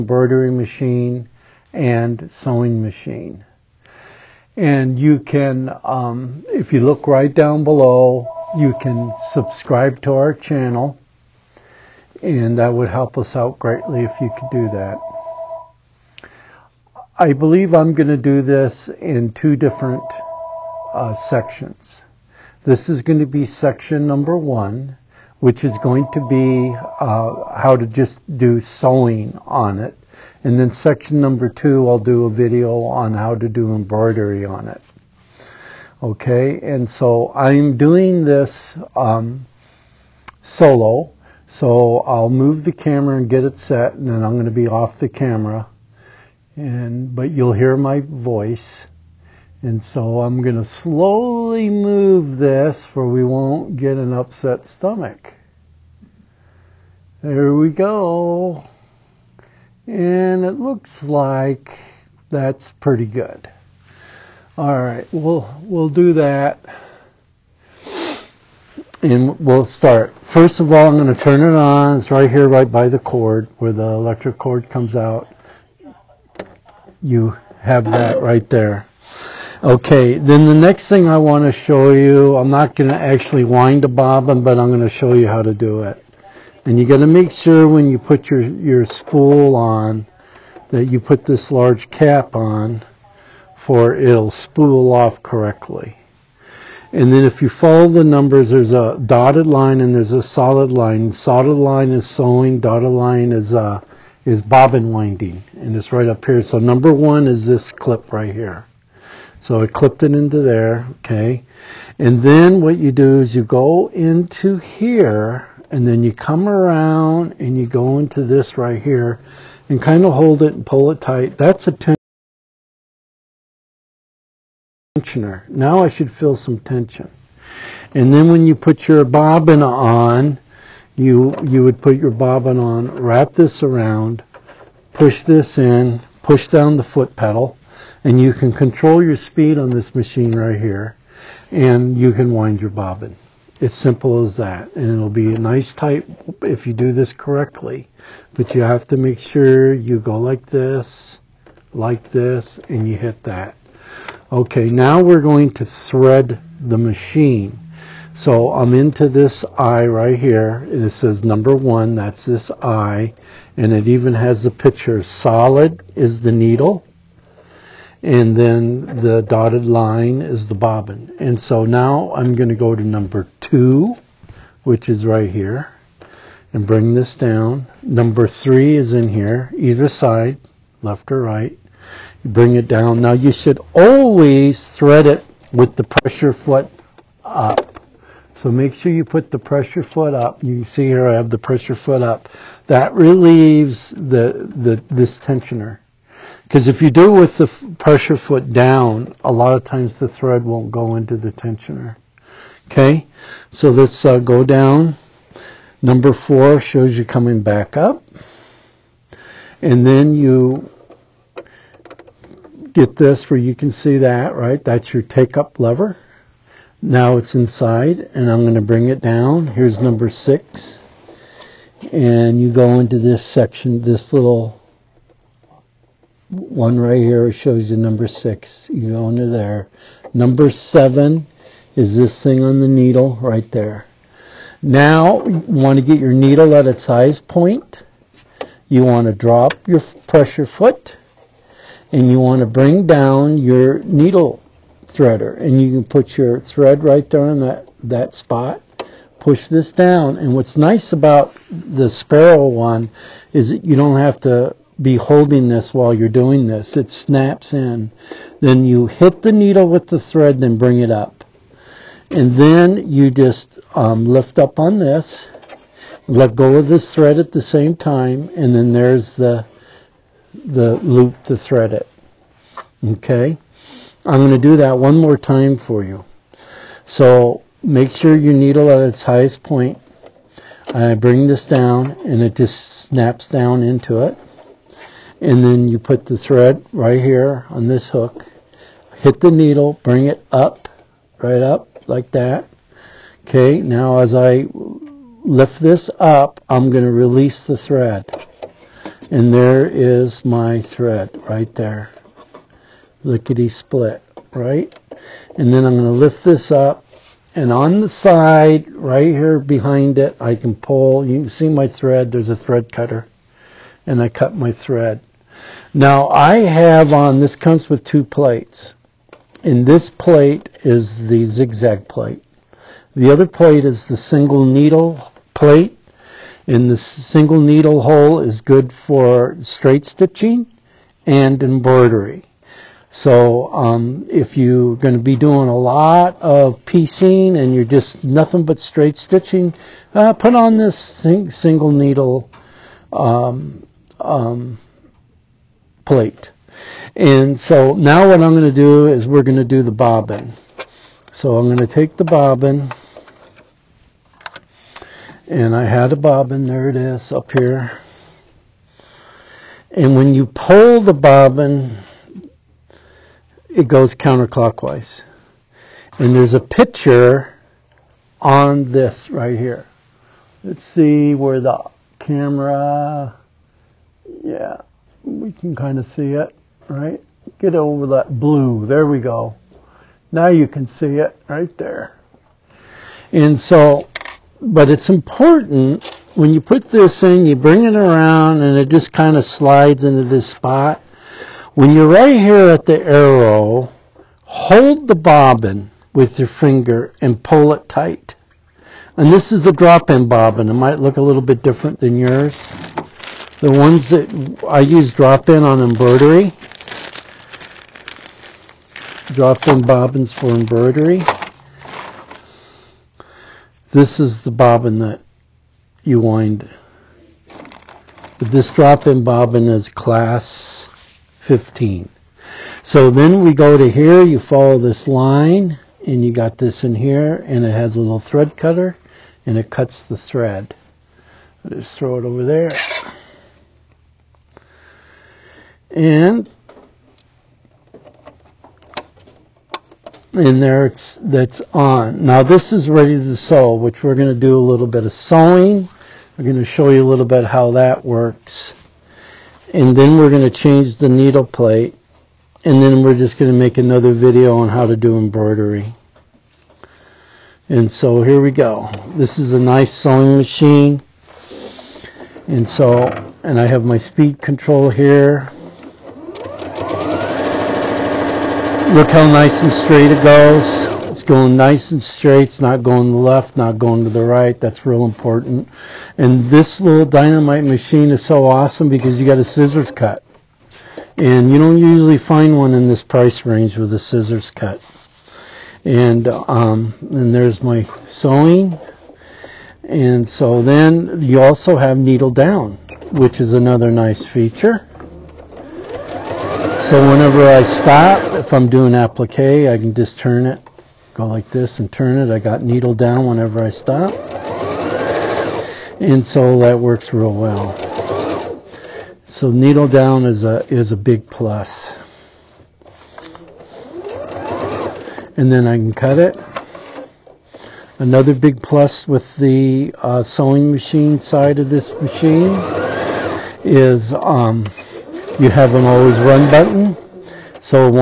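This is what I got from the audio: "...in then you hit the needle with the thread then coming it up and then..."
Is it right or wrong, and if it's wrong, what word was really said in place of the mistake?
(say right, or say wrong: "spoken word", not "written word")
wrong: "bring", not "coming".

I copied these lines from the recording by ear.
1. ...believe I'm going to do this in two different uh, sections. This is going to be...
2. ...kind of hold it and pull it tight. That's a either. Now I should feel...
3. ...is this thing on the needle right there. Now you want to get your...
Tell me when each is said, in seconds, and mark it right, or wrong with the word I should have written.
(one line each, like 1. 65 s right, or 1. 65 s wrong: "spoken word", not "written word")
1. 17 s right
2. 119 s wrong: "tensioner", not "either"
3. 231 s right.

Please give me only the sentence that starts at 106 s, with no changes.
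So number one is this clip right here.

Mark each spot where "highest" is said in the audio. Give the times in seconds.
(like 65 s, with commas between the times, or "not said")
236 s, 279 s.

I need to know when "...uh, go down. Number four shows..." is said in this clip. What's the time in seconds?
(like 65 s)
204 s.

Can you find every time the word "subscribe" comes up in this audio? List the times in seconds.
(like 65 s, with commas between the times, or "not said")
9 s.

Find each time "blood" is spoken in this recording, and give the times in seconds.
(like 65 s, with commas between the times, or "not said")
not said.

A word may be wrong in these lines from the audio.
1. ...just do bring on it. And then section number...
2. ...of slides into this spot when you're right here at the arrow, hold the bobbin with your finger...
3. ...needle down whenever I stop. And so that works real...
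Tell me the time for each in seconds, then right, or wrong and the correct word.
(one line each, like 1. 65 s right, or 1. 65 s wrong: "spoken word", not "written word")
1. 27 s wrong: "sewing", not "bring"
2. 389 s right
3. 502 s right.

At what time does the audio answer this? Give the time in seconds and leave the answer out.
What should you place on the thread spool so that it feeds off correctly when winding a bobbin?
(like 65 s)
91 s.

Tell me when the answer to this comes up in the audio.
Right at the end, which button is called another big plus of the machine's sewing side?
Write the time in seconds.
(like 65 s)
525 s.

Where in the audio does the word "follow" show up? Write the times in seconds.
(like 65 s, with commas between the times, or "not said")
97 s, 424 s.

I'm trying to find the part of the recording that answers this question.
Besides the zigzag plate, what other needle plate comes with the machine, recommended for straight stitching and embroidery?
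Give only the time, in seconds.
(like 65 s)
323 s.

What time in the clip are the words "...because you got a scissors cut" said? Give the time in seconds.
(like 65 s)
478 s.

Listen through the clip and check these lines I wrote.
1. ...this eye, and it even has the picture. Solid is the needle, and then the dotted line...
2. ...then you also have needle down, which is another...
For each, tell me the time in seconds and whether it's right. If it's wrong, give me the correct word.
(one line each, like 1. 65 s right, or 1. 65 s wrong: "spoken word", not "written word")
1. 162 s right
2. 490 s right.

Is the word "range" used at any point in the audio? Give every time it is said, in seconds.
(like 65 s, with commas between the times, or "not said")
483 s.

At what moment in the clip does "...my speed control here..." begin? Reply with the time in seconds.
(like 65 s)
463 s.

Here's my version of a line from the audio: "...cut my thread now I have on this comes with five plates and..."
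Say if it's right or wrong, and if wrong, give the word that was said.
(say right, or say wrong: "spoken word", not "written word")
wrong: "two", not "five".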